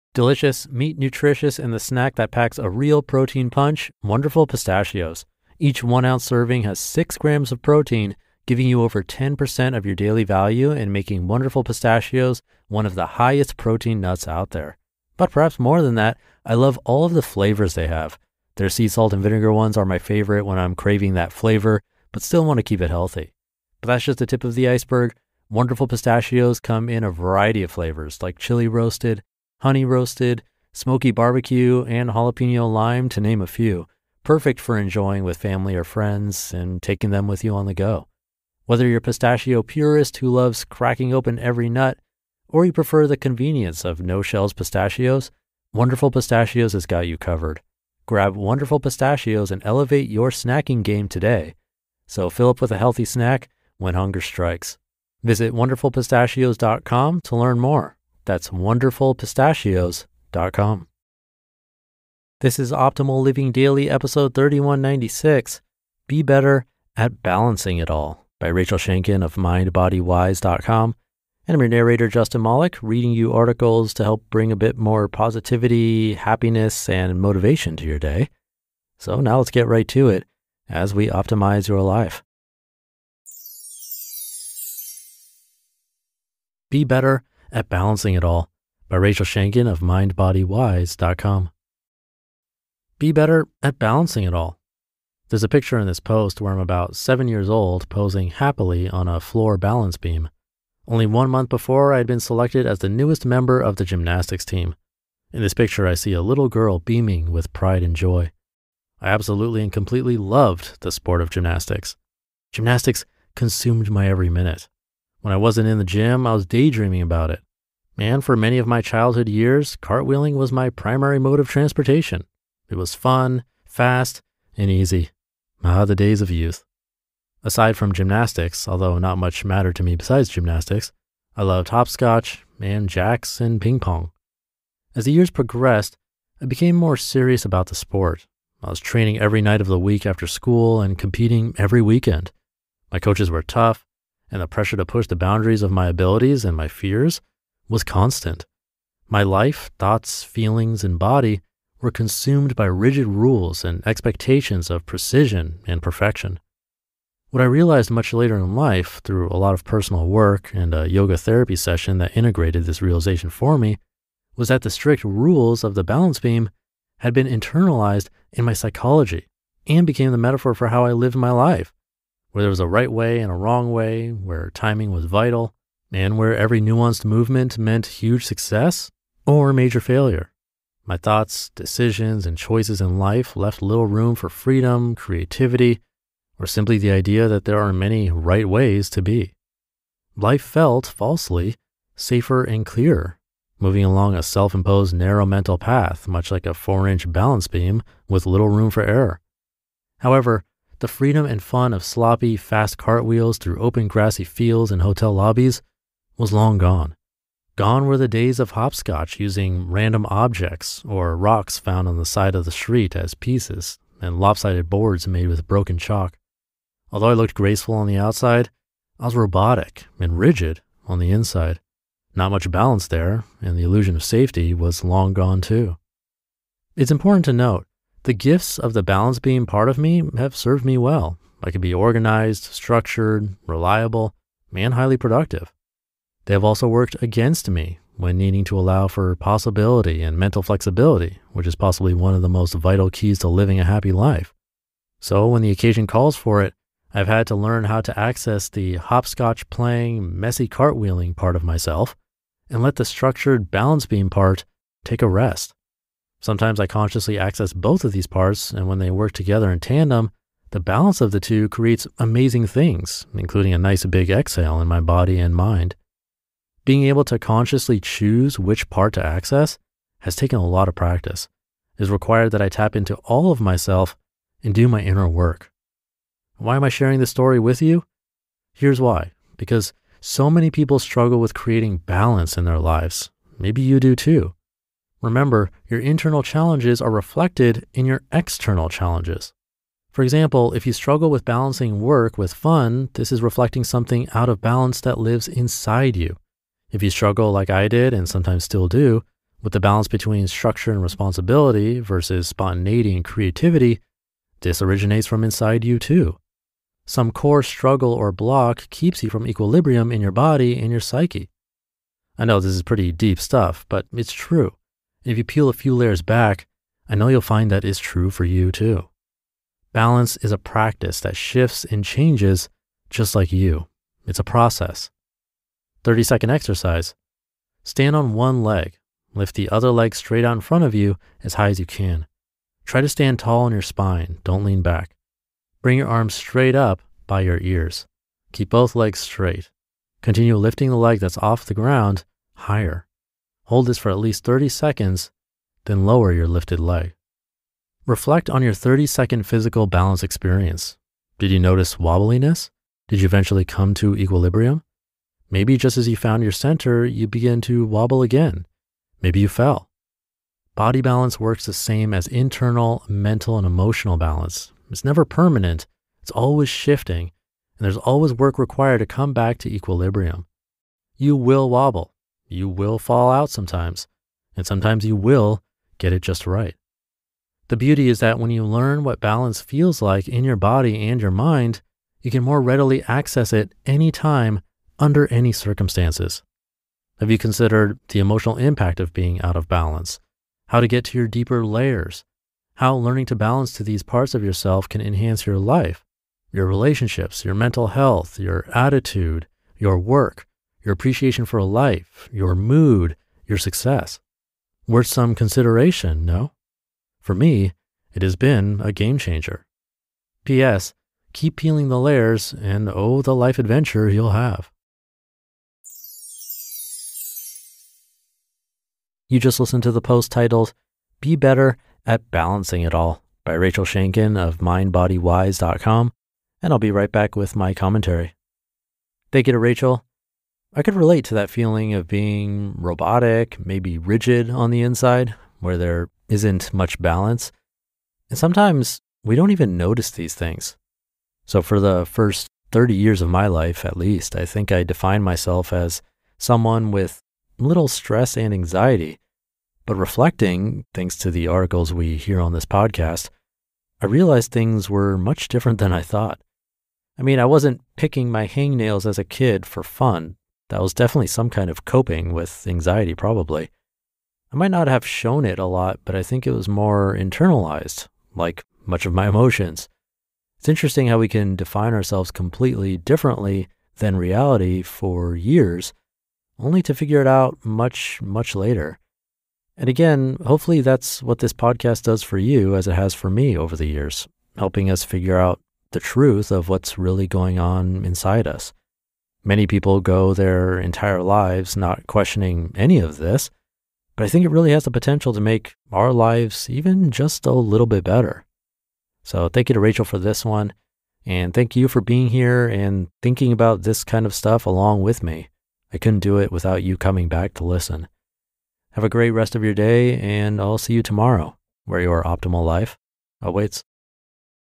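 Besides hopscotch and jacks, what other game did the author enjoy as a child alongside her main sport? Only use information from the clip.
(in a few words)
Ping pong.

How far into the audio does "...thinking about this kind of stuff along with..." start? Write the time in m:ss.
8:23.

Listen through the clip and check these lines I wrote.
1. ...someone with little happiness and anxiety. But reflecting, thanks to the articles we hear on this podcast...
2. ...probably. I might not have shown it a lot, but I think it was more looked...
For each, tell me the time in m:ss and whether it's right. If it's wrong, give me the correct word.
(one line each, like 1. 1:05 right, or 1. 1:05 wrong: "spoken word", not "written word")
1. 7:26 wrong: "stress", not "happiness"
2. 7:42 wrong: "internalized", not "looked".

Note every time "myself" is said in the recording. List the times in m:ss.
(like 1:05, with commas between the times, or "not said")
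4:11, 4:33, 7:25.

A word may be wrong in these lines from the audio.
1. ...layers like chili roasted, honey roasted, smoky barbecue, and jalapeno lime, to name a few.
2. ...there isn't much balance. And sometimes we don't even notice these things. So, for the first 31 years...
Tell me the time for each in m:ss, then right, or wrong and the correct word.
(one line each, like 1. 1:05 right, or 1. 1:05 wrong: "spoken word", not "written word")
1. 0:27 wrong: "flavors", not "layers"
2. 7:15 wrong: "30", not "31".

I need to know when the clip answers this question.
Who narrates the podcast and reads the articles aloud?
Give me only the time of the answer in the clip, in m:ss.
1:12.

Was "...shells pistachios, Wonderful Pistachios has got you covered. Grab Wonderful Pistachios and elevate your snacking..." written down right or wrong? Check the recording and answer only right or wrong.
right.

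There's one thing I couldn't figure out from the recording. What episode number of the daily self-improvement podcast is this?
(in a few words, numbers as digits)
3196.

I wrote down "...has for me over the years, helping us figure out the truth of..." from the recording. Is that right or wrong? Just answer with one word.
right.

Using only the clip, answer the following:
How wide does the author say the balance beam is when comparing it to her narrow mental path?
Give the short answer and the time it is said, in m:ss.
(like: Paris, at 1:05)
4 inch, at 3:16.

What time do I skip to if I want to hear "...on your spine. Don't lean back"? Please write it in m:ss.
5:33.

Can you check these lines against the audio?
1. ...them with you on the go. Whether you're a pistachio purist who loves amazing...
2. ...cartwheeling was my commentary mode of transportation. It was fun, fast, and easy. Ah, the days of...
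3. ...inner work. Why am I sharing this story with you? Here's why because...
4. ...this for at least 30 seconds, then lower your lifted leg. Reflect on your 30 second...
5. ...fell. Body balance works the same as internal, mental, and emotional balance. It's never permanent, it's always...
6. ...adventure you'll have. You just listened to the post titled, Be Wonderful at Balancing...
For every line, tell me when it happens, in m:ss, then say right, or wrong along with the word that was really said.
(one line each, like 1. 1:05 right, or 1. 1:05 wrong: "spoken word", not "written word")
1. 0:37 wrong: "cracking", not "amazing"
2. 1:59 wrong: "primary", not "commentary"
3. 4:34 right
4. 5:43 right
5. 5:59 right
6. 6:53 wrong: "Better", not "Wonderful".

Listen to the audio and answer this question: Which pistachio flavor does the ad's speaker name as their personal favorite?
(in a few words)
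Sea salt and vinegar.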